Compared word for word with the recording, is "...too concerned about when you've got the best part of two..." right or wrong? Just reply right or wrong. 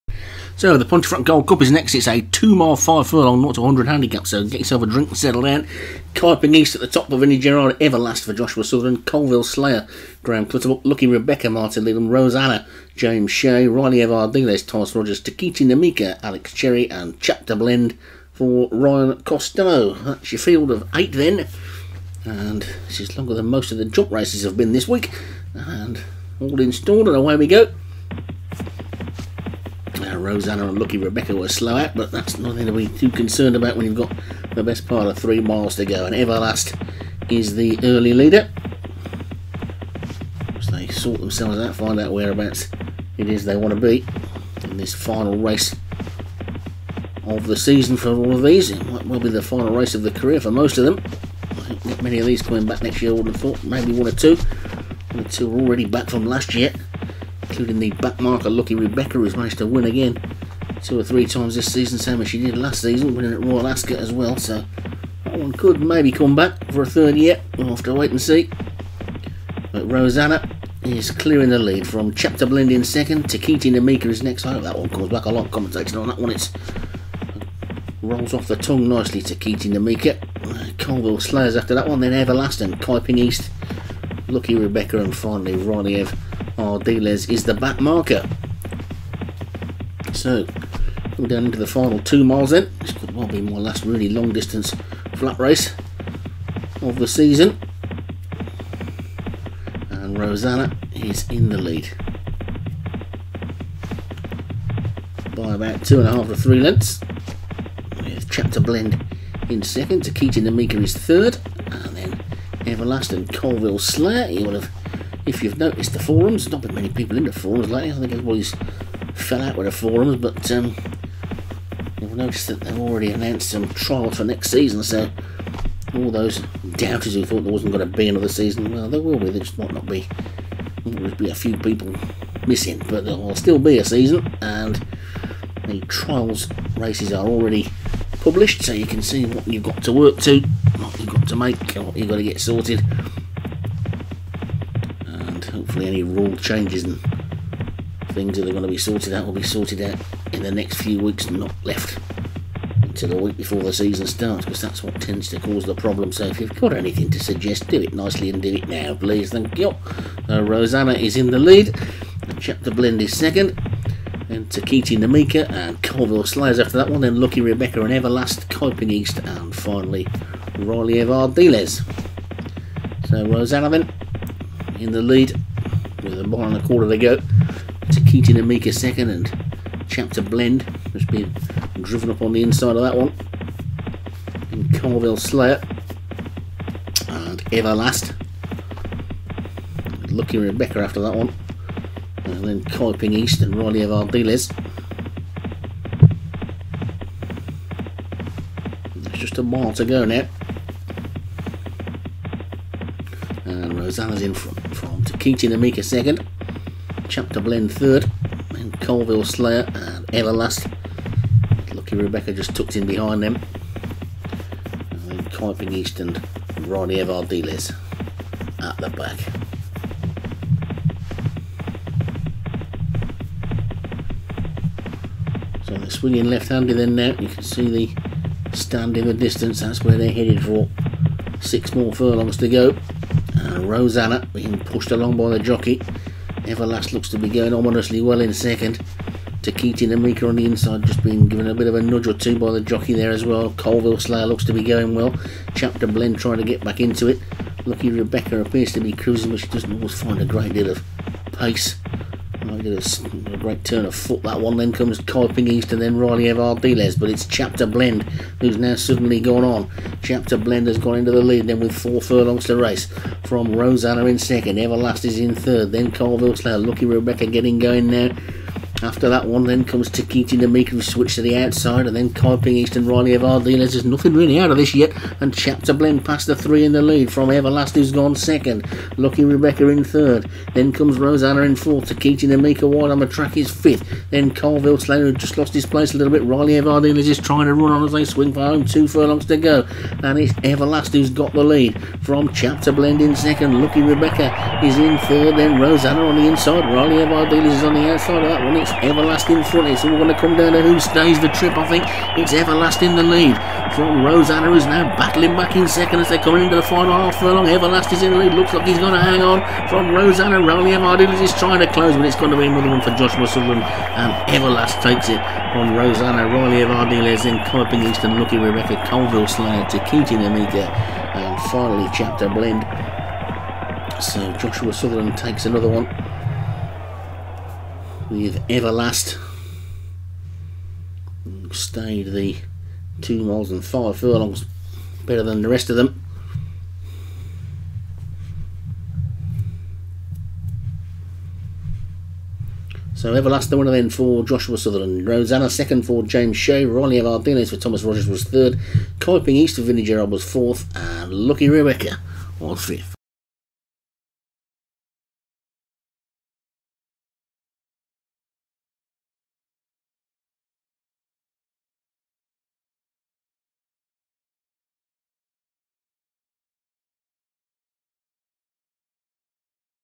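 wrong.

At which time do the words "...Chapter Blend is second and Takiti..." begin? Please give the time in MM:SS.
02:42.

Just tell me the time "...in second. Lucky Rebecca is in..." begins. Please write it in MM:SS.
04:53.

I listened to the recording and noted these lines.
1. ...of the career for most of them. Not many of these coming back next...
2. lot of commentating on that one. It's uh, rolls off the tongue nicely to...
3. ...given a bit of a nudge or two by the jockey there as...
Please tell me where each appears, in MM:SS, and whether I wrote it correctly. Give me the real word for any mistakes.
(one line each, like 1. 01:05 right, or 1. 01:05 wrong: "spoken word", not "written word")
1. 00:49 right
2. 01:15 right
3. 04:01 right.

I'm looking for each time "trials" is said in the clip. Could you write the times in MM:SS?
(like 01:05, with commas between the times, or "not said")
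02:03, 02:15.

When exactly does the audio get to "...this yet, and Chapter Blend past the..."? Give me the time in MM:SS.
04:34.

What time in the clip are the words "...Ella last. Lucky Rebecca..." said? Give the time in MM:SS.
03:30.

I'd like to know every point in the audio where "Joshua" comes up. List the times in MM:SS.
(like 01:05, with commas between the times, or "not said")
00:08, 05:12, 05:24, 05:44.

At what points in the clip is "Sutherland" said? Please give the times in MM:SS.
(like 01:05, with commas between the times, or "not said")
05:13, 05:24, 05:44.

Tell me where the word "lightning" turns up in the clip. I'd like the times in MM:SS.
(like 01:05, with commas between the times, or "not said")
not said.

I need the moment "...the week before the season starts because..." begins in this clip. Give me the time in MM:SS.
02:33.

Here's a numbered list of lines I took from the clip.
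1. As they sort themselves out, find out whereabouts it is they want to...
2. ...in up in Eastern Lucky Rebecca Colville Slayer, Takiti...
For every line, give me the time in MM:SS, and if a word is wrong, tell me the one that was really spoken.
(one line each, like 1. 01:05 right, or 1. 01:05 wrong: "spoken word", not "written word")
1. 00:40 right
2. 05:17 right.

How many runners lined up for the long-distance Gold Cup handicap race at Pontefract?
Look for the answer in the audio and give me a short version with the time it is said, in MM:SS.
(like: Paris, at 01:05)
8, at 00:20.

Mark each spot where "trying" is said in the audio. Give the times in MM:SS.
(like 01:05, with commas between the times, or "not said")
04:06, 04:47, 05:11.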